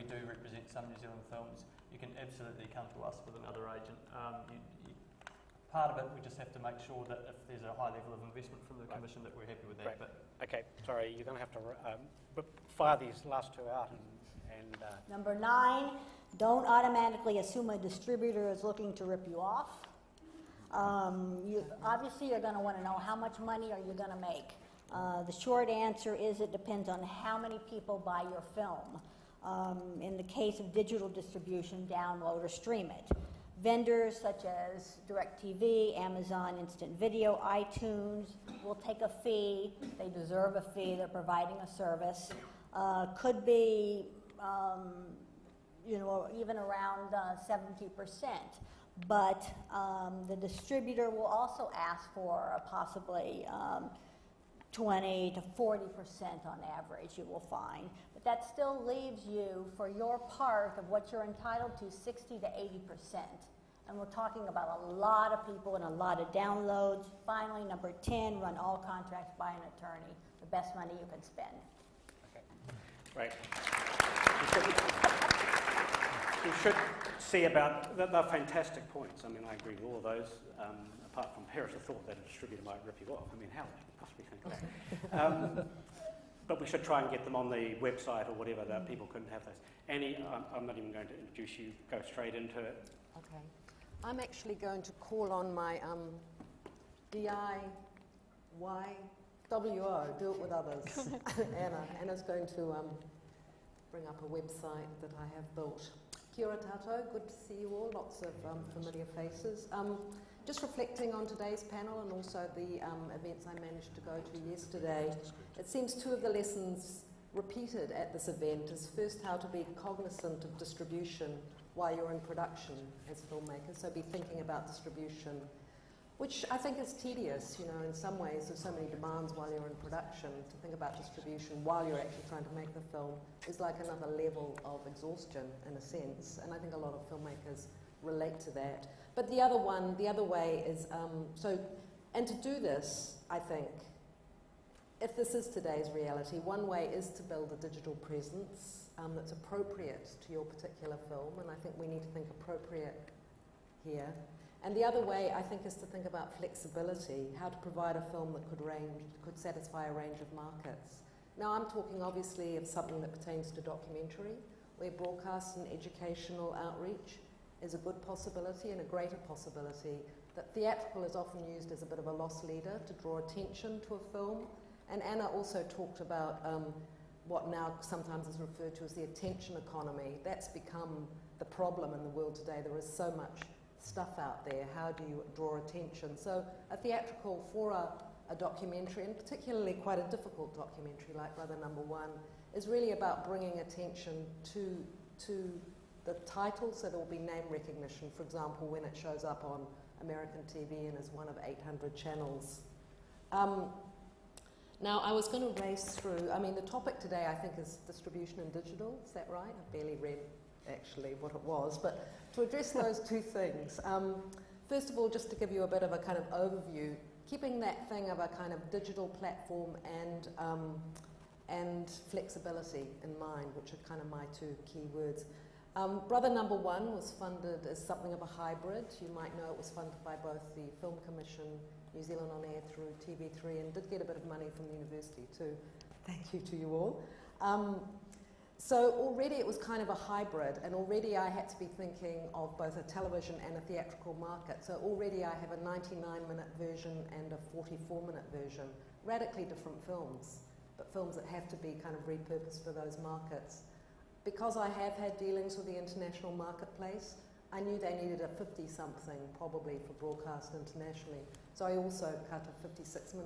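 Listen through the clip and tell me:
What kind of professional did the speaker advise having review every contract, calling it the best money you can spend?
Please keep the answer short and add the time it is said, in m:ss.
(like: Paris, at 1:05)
An attorney, at 1:09.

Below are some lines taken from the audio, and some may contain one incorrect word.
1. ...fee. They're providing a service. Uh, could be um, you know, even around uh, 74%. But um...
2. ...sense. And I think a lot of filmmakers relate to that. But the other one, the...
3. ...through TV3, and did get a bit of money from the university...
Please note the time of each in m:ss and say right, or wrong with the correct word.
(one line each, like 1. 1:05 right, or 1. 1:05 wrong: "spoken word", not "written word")
1. 0:40 wrong: "70", not "74"
2. 2:15 right
3. 3:52 right.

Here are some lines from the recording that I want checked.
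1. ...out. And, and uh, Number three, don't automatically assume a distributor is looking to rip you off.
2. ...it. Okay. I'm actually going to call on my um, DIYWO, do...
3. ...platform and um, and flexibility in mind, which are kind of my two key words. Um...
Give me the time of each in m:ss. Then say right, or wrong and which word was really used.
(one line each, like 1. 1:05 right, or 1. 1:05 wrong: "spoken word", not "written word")
1. 0:13 wrong: "nine", not "three"
2. 1:32 right
3. 3:39 right.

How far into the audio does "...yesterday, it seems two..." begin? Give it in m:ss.
1:54.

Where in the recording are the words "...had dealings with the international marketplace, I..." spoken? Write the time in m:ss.
4:14.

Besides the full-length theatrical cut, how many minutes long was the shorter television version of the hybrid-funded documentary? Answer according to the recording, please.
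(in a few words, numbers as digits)
44 minutes.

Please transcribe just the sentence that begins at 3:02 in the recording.
There is so much stuff out there?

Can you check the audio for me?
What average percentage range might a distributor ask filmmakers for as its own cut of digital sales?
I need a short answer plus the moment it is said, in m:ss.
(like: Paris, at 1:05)
20 to 40%, at 0:54.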